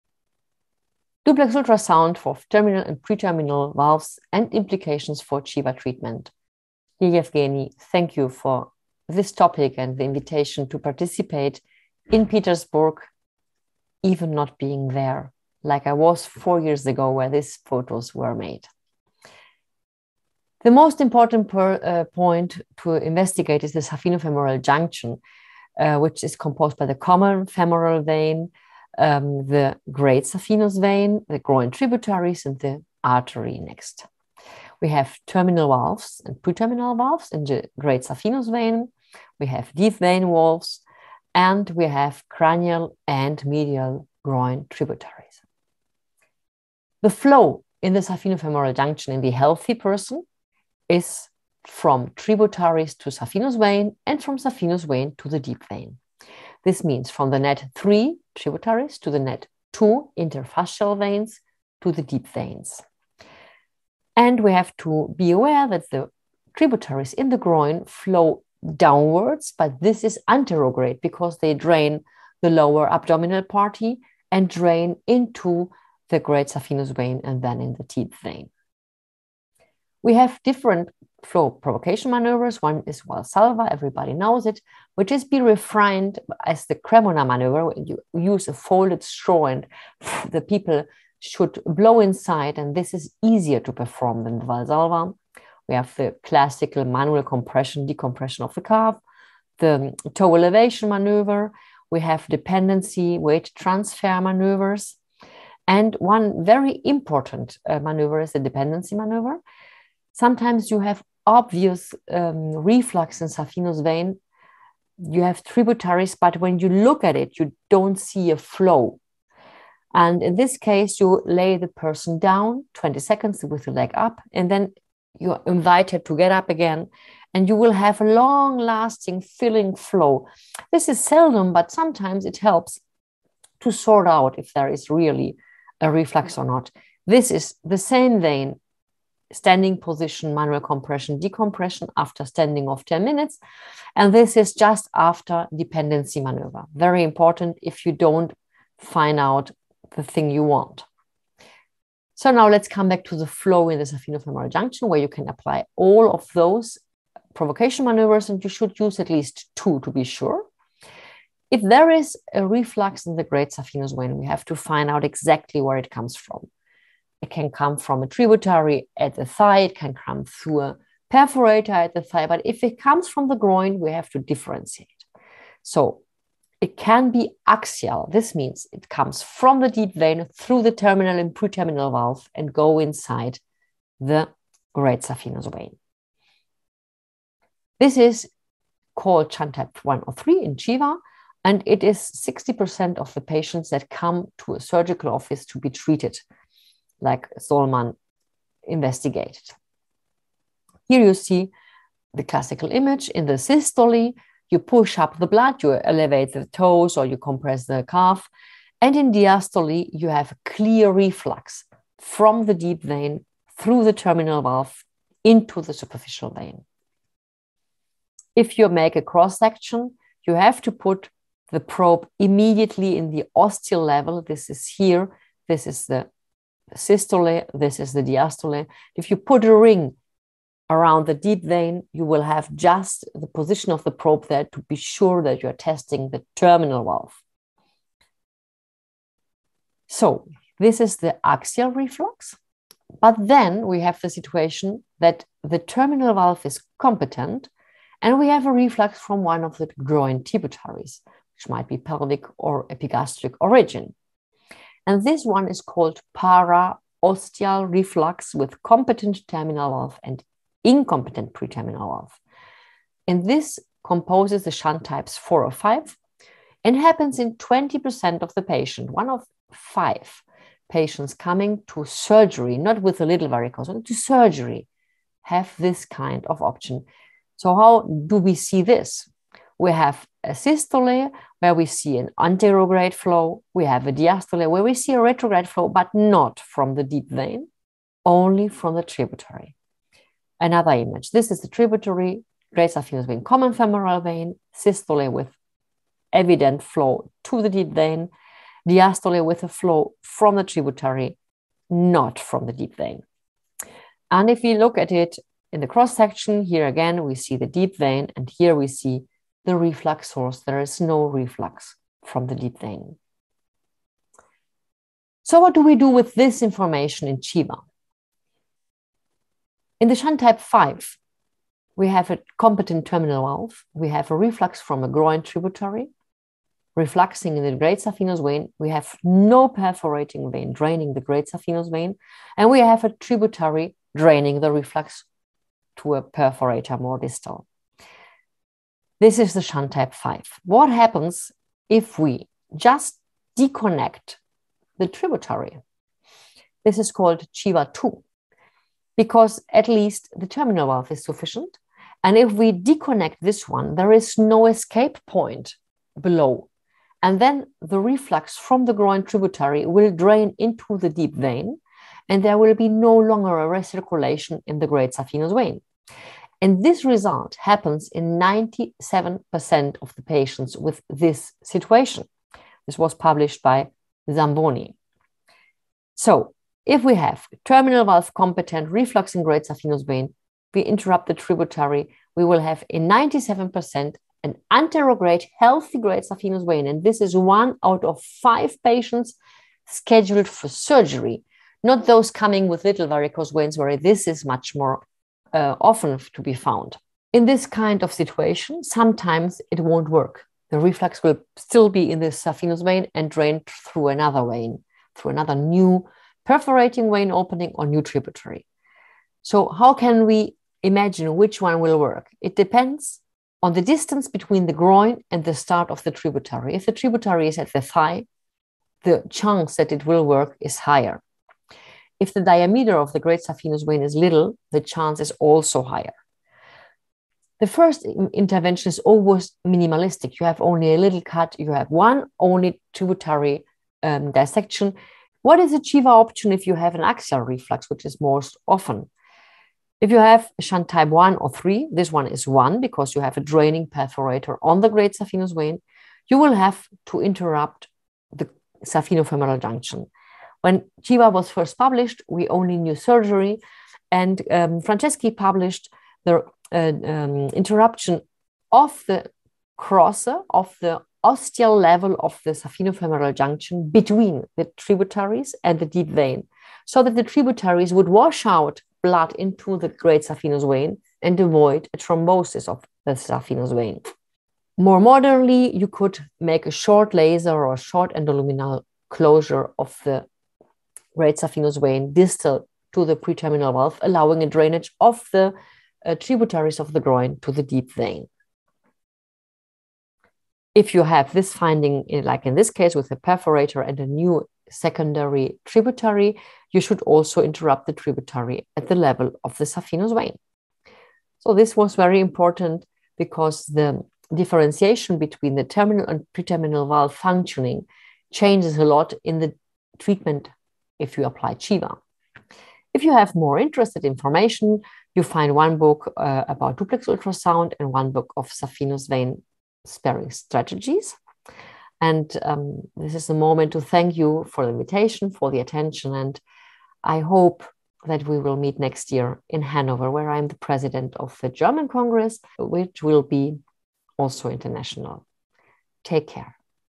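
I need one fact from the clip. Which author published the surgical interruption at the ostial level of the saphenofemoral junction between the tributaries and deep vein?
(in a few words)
Franceschi.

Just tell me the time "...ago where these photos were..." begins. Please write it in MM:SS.
00:16.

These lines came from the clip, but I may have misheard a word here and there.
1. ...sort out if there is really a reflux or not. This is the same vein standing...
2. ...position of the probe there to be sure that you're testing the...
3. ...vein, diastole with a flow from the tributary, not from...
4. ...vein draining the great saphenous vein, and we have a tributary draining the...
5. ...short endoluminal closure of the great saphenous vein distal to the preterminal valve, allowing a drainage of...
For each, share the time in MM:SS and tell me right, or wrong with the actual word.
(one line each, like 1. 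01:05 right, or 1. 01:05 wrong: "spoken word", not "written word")
1. 02:13 right
2. 03:53 right
3. 04:57 right
4. 05:30 right
5. 07:57 right.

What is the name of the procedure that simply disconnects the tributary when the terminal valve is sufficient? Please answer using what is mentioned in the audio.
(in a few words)
Chiva 2.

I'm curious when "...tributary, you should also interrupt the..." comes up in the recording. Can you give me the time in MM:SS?
08:15.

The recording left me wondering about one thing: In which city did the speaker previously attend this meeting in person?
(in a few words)
Petersburg.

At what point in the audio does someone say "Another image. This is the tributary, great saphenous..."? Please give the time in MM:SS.
04:50.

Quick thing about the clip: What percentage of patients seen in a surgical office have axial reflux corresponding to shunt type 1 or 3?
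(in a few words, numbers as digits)
60%.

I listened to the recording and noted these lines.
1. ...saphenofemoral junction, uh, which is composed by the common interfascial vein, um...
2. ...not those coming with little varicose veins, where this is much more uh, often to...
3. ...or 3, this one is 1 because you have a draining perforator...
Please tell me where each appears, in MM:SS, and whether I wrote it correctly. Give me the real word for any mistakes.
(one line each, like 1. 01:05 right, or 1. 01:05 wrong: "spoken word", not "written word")
1. 00:23 wrong: "femoral", not "interfascial"
2. 06:31 right
3. 07:21 right.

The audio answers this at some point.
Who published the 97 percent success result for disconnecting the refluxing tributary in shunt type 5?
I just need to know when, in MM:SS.
06:14.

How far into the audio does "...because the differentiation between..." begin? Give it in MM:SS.
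08:22.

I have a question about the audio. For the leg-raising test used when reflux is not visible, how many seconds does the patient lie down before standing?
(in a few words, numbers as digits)
20.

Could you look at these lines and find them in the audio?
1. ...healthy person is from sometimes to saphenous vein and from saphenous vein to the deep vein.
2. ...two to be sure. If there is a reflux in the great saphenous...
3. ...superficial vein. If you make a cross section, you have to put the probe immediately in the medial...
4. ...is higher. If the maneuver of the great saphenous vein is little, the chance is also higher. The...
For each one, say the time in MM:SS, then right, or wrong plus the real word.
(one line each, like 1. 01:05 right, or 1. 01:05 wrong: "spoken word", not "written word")
1. 00:49 wrong: "tributaries", not "sometimes"
2. 02:39 right
3. 03:35 wrong: "ostial", not "medial"
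4. 07:00 wrong: "diameter", not "maneuver".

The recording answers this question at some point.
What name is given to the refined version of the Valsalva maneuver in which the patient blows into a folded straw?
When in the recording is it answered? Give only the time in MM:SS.
01:26.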